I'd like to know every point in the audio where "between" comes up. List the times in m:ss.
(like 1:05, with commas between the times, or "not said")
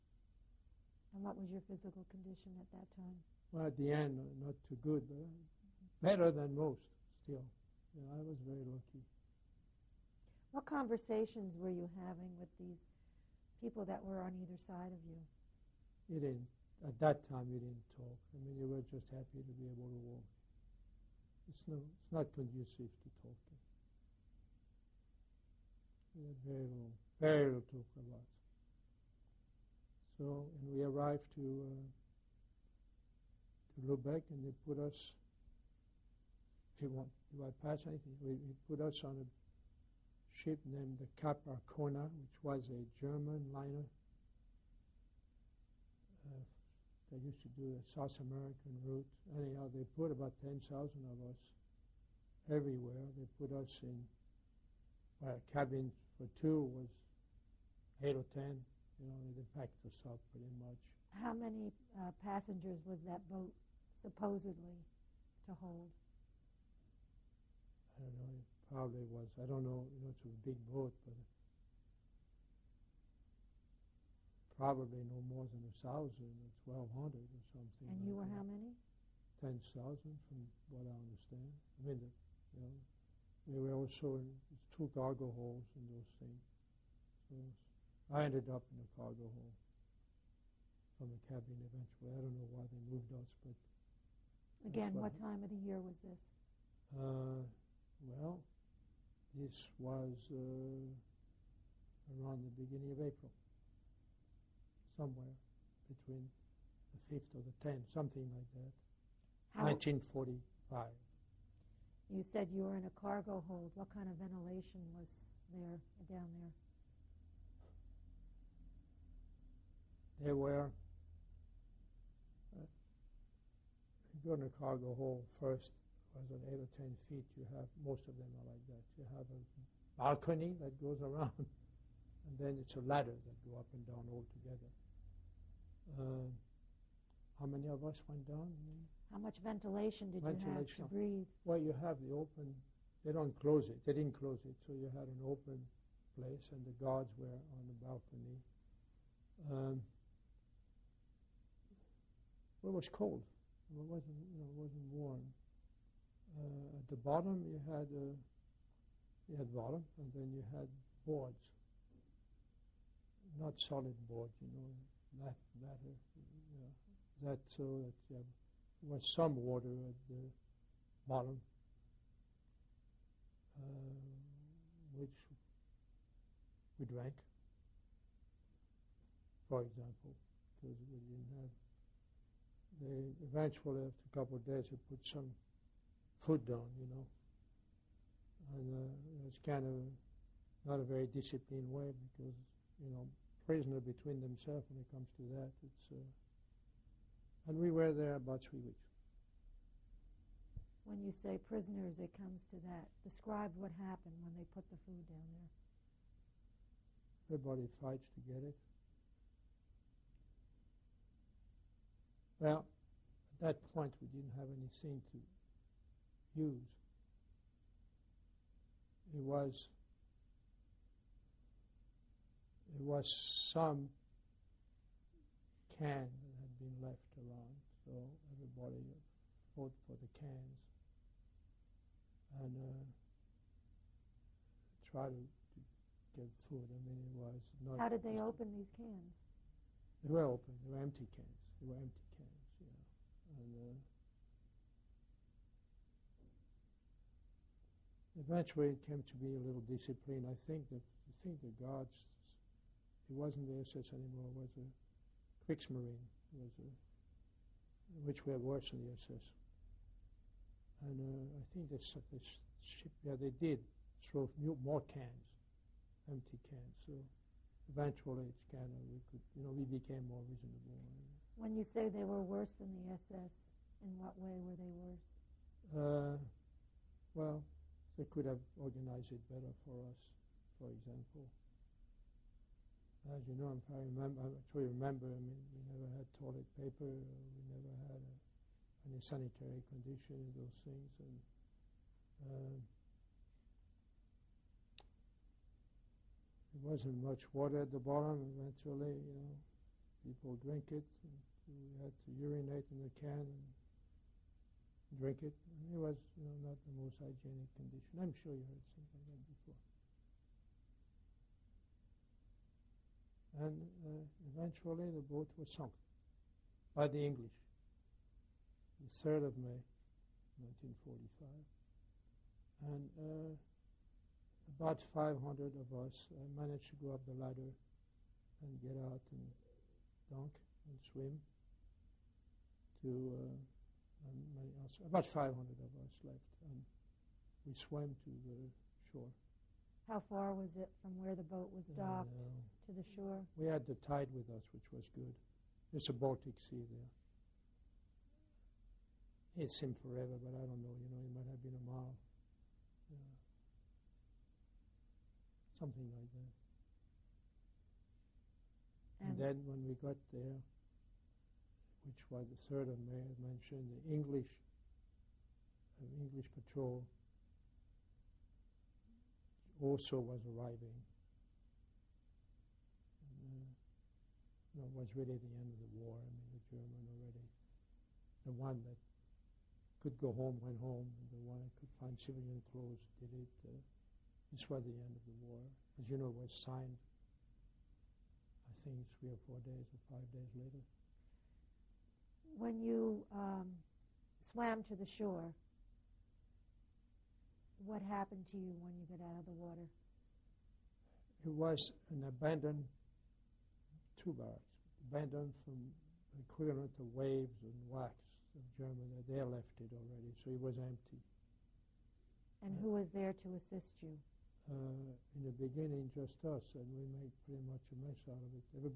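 1:45, 3:13.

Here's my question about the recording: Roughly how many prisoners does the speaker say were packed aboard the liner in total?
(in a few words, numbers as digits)
10,000.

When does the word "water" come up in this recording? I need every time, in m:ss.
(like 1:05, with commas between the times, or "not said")
2:49, 4:57, 6:39.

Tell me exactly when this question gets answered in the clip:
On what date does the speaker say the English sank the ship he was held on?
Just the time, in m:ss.
5:19.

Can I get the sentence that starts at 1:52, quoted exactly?
You said you were in a cargo hold.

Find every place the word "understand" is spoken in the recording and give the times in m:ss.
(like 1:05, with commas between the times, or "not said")
1:20.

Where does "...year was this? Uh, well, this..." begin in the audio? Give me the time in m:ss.
1:35.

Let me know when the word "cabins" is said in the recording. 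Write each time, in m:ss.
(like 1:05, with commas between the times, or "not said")
0:55, 1:31.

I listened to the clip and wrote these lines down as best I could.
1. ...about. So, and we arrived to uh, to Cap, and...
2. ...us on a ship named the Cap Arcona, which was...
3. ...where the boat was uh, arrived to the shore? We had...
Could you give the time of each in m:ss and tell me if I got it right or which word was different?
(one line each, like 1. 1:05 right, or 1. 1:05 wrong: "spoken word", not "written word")
1. 0:27 wrong: "Lubeck", not "Cap"
2. 0:38 right
3. 5:41 wrong: "docked", not "arrived".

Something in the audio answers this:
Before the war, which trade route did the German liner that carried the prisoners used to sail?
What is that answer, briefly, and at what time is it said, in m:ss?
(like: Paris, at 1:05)
South American route, at 0:47.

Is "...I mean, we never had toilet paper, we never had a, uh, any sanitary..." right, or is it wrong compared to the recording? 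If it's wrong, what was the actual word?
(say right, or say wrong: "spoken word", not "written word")
right.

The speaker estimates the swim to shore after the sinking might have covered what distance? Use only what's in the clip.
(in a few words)
a mile.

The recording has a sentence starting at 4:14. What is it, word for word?
It was a Kriegsmarine, was a, which were worse than the SS.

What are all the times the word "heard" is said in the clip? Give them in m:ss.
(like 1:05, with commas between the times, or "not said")
5:08.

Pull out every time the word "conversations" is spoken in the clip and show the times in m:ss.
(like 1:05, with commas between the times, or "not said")
0:10.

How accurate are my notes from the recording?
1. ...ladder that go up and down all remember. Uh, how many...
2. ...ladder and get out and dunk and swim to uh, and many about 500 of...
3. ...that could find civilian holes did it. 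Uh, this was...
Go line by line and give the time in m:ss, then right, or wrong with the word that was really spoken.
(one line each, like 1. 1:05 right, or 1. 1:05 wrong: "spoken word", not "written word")
1. 2:12 wrong: "together", not "remember"
2. 5:27 right
3. 6:21 wrong: "clothes", not "holes".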